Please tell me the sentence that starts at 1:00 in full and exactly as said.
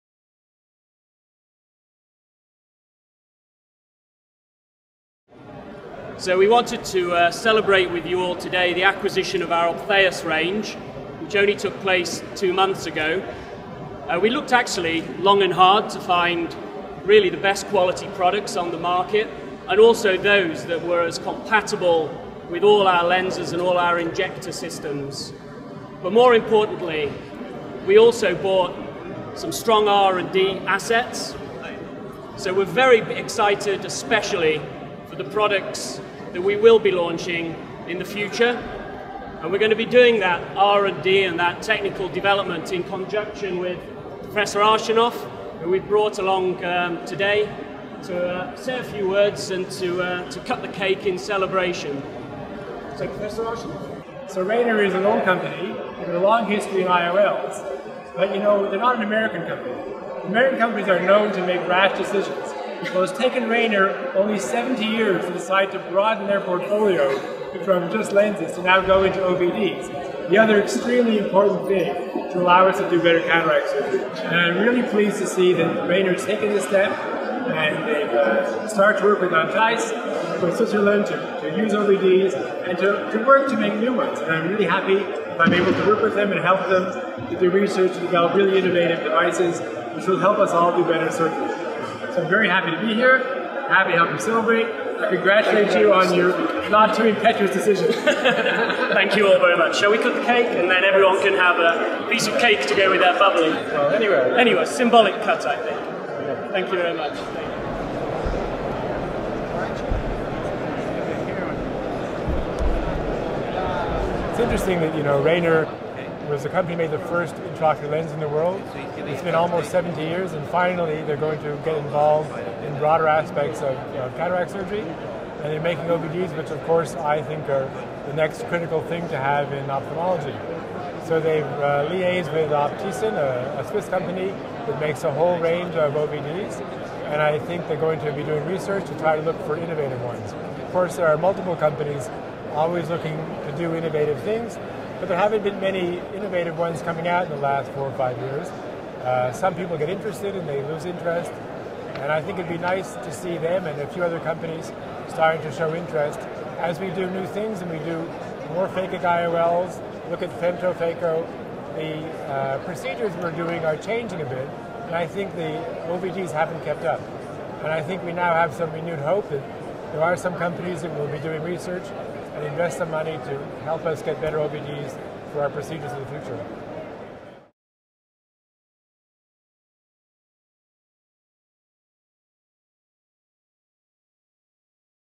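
American companies are known to make rash decisions.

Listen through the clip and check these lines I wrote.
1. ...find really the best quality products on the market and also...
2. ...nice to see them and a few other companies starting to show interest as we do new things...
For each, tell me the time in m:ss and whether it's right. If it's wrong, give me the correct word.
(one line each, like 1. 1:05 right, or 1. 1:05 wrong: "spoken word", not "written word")
1. 0:15 right
2. 2:32 right.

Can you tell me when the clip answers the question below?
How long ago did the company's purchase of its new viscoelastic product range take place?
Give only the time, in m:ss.
0:12.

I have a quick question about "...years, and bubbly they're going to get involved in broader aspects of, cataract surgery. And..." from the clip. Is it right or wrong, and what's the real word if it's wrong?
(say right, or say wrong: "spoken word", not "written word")
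wrong: "finally", not "bubbly".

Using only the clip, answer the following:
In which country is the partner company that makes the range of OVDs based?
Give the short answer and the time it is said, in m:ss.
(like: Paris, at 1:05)
Switzerland, at 1:20.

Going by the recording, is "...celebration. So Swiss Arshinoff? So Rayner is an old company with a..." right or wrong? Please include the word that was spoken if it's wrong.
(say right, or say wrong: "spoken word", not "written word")
wrong: "Professor", not "Swiss".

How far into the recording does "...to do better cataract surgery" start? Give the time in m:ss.
1:12.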